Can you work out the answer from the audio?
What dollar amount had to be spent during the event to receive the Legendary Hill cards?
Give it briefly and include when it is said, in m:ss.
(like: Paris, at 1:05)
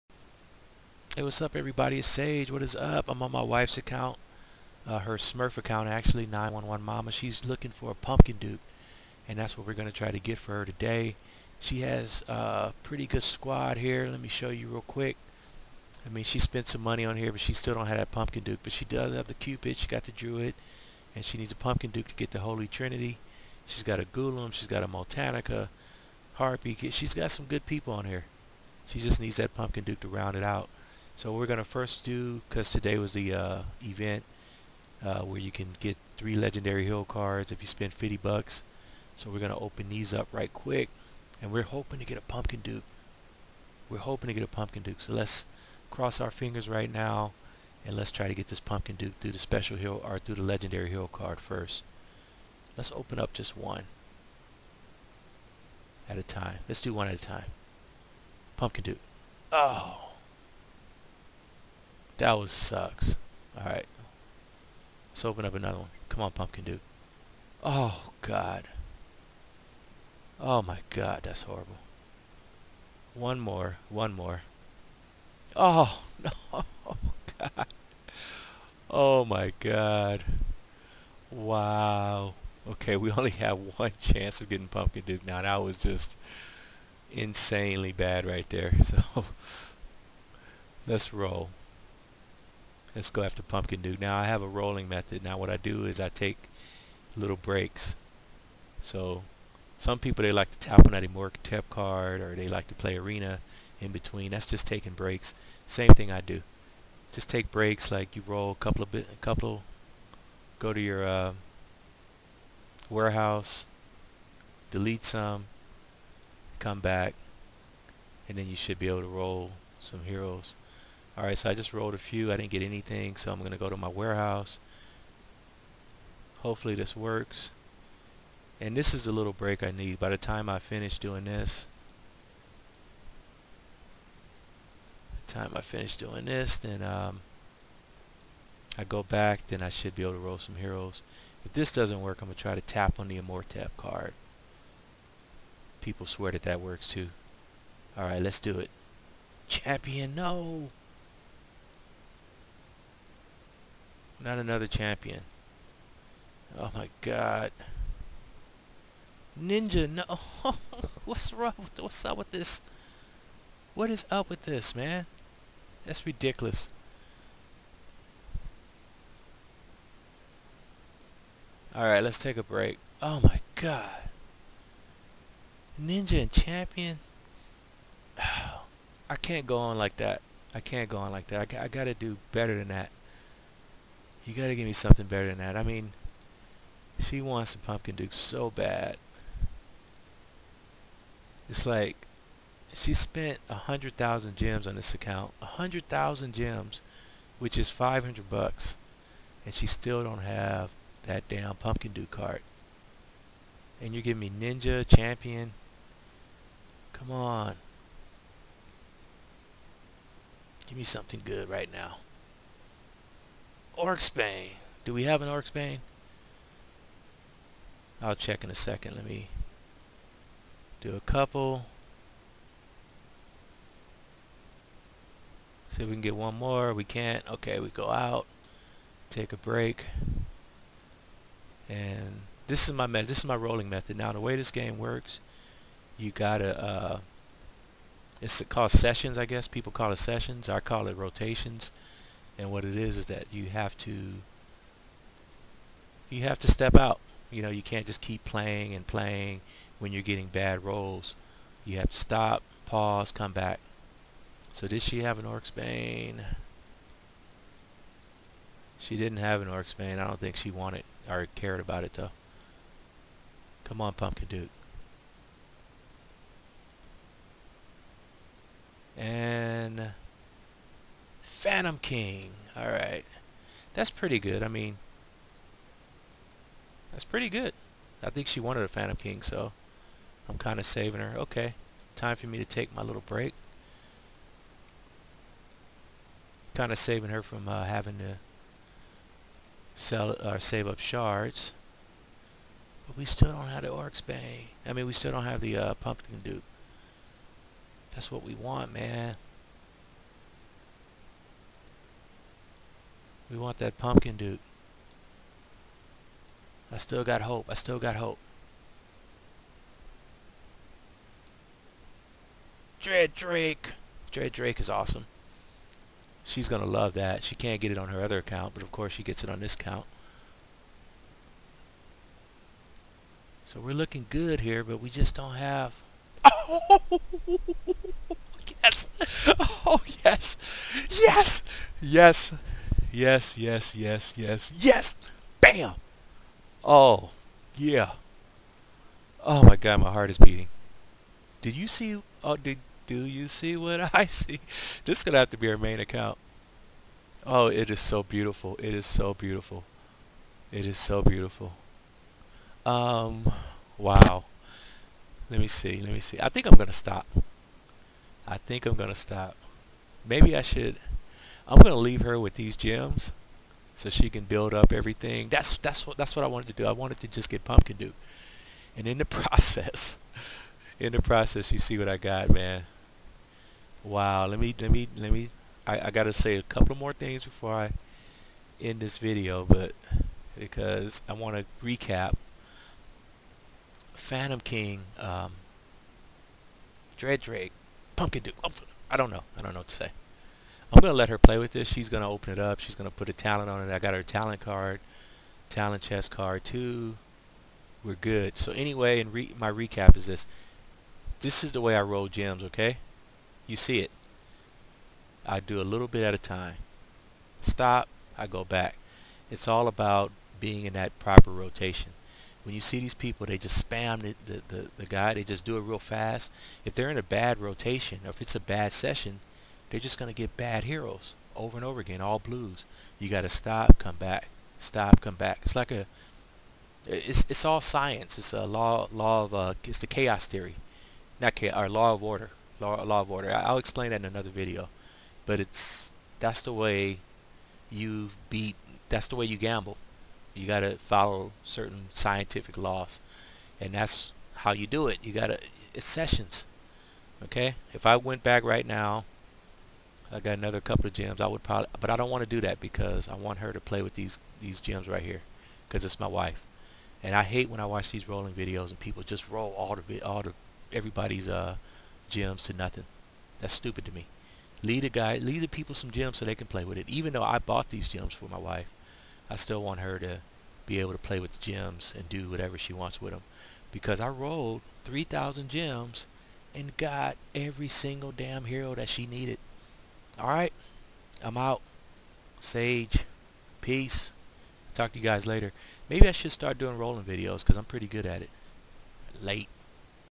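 $50, at 0:37.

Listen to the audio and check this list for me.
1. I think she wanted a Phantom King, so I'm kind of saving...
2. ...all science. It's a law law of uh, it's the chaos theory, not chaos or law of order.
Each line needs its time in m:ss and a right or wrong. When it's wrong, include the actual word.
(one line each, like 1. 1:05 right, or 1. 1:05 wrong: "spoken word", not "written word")
1. 4:38 right
2. 7:07 right.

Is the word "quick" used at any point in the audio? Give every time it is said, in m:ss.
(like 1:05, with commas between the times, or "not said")
0:14, 0:40.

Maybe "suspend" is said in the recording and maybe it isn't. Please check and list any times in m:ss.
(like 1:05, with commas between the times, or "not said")
not said.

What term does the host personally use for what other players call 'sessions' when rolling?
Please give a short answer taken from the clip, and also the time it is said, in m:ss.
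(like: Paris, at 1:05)
rotations, at 4:00.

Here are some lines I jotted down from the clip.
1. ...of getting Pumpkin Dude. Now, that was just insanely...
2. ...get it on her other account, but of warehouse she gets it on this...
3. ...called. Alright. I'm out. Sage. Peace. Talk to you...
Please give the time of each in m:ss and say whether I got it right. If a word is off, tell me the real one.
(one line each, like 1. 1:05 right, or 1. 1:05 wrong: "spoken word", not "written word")
1. 1:24 right
2. 5:17 wrong: "course", not "warehouse"
3. 7:59 wrong: "needed", not "called".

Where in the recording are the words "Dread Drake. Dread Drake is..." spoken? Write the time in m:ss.
5:12.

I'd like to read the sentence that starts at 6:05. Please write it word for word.
That's that's what that's what I wanted to do.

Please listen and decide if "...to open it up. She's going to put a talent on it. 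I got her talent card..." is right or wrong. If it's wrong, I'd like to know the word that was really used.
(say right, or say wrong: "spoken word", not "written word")
right.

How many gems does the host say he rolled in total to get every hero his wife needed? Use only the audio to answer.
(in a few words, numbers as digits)
3,000.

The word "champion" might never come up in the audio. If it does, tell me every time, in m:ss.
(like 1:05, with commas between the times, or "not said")
2:29, 2:34, 2:56, 3:24.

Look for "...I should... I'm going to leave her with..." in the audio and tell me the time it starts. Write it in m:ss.
6:00.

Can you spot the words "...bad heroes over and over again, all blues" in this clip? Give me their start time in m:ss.
7:00.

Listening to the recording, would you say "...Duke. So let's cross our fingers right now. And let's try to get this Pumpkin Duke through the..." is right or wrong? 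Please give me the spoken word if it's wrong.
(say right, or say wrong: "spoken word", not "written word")
right.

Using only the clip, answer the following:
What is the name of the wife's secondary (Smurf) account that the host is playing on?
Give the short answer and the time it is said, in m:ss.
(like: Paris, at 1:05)
911 Mama, at 0:06.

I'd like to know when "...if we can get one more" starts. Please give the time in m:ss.
3:45.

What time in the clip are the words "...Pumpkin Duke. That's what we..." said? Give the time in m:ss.
4:55.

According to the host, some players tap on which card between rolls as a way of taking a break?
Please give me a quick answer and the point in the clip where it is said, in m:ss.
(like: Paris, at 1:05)
Amorc tap card, at 1:41.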